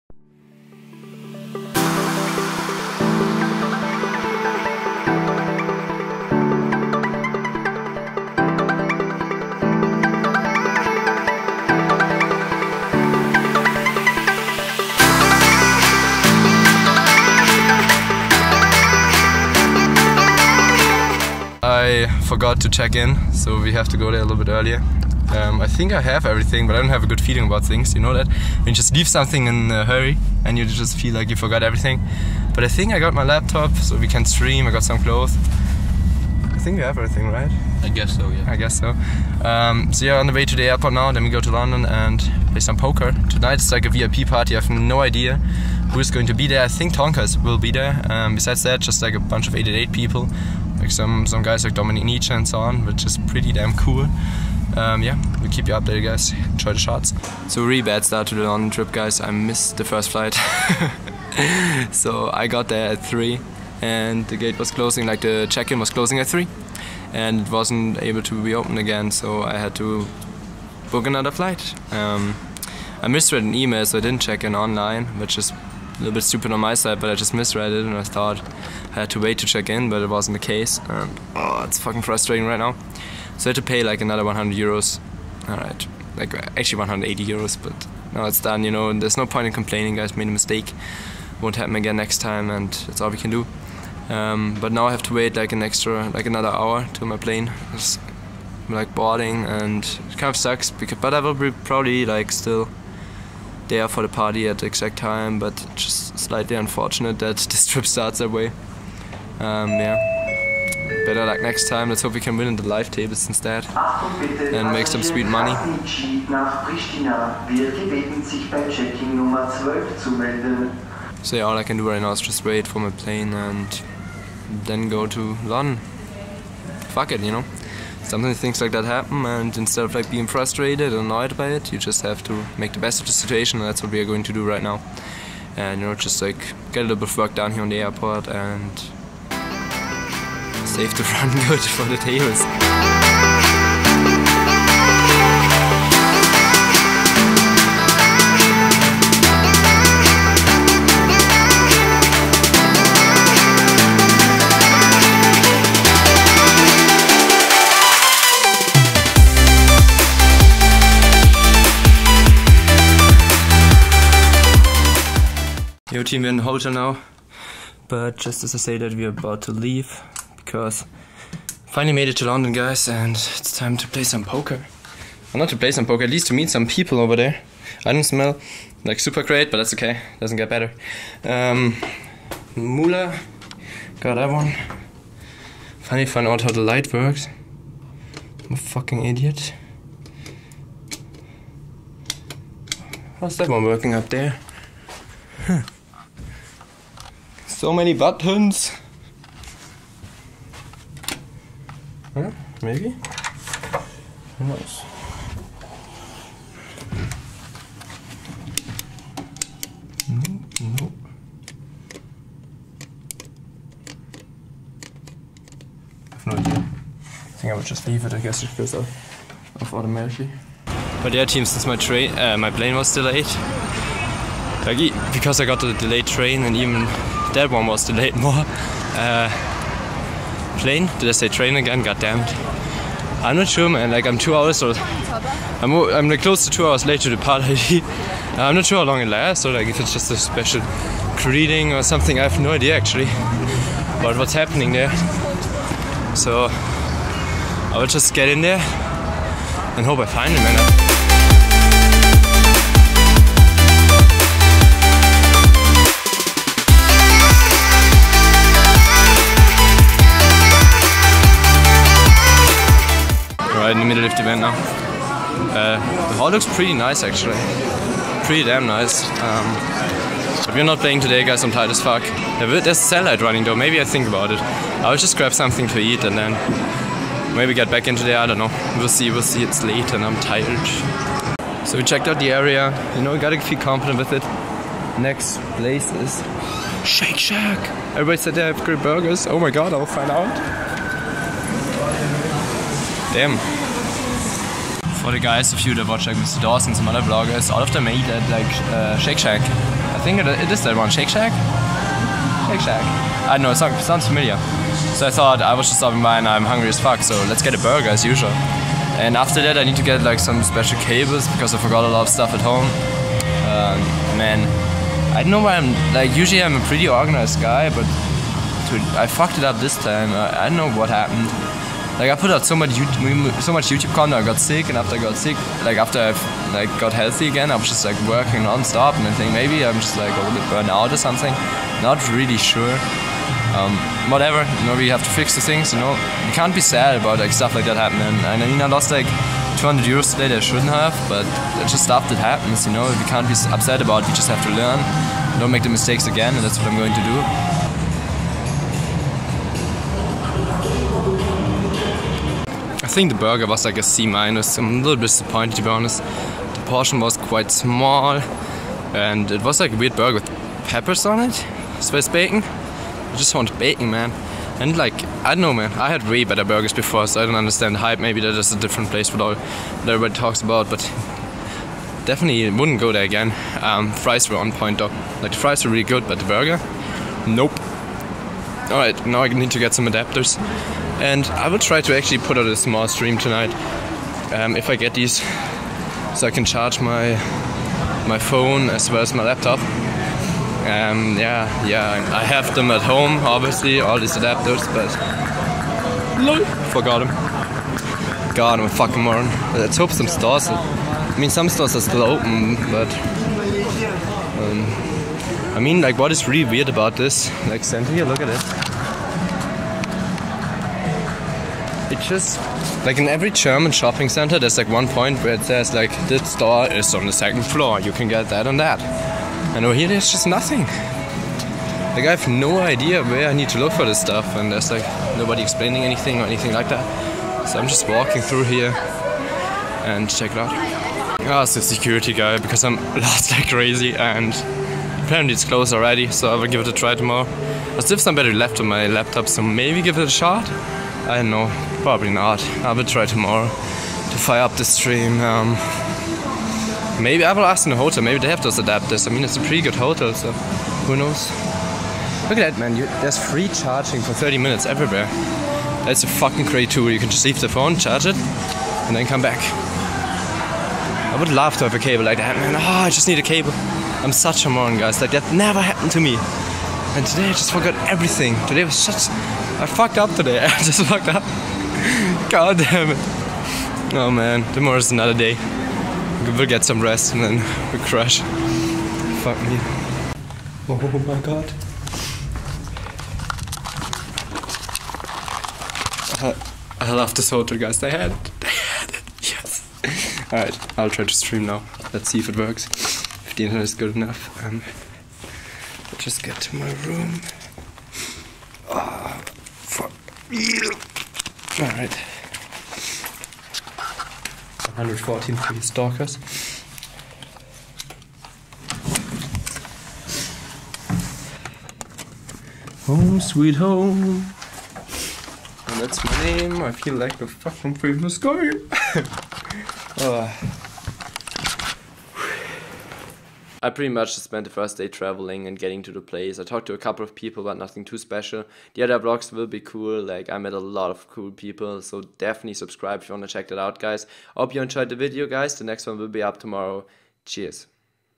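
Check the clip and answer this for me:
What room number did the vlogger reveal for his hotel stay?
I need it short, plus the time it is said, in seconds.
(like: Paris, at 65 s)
114, at 504 s.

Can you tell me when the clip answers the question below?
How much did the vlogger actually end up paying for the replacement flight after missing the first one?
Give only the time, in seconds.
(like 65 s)
86 s.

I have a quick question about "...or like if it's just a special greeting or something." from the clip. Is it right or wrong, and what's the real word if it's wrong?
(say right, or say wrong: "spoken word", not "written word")
right.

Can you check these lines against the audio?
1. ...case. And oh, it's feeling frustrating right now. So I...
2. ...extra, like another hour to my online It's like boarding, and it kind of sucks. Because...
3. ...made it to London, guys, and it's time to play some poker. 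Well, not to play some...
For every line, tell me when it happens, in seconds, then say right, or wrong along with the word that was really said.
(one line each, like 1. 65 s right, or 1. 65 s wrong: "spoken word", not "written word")
1. 80 s wrong: "fucking", not "feeling"
2. 95 s wrong: "plane", not "online"
3. 171 s right.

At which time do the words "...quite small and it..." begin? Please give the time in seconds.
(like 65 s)
357 s.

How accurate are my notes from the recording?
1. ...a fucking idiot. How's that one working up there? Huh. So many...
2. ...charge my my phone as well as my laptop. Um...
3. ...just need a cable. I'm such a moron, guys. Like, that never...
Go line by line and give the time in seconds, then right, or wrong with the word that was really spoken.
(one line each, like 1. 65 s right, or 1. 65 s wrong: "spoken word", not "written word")
1. 188 s right
2. 386 s right
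3. 462 s right.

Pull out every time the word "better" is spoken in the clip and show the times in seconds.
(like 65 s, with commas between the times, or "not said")
111 s, 180 s, 366 s.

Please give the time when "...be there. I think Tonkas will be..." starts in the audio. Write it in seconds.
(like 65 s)
46 s.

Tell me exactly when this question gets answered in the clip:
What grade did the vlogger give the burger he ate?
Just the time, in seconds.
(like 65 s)
353 s.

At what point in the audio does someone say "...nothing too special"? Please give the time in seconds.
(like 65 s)
527 s.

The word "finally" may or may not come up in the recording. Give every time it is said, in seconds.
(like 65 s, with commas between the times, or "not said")
171 s, 185 s.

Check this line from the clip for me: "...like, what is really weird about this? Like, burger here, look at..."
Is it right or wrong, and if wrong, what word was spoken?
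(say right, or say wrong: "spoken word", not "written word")
wrong: "center", not "burger".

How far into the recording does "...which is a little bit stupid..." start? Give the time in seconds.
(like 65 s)
75 s.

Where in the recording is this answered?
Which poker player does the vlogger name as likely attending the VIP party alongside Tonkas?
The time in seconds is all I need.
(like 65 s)
51 s.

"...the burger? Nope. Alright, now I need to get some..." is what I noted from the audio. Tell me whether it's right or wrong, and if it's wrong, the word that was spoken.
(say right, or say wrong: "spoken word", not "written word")
right.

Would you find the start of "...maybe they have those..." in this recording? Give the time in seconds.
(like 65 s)
448 s.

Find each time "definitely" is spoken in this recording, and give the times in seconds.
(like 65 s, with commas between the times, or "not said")
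372 s, 532 s.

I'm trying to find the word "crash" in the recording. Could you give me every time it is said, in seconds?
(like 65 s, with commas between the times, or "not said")
477 s.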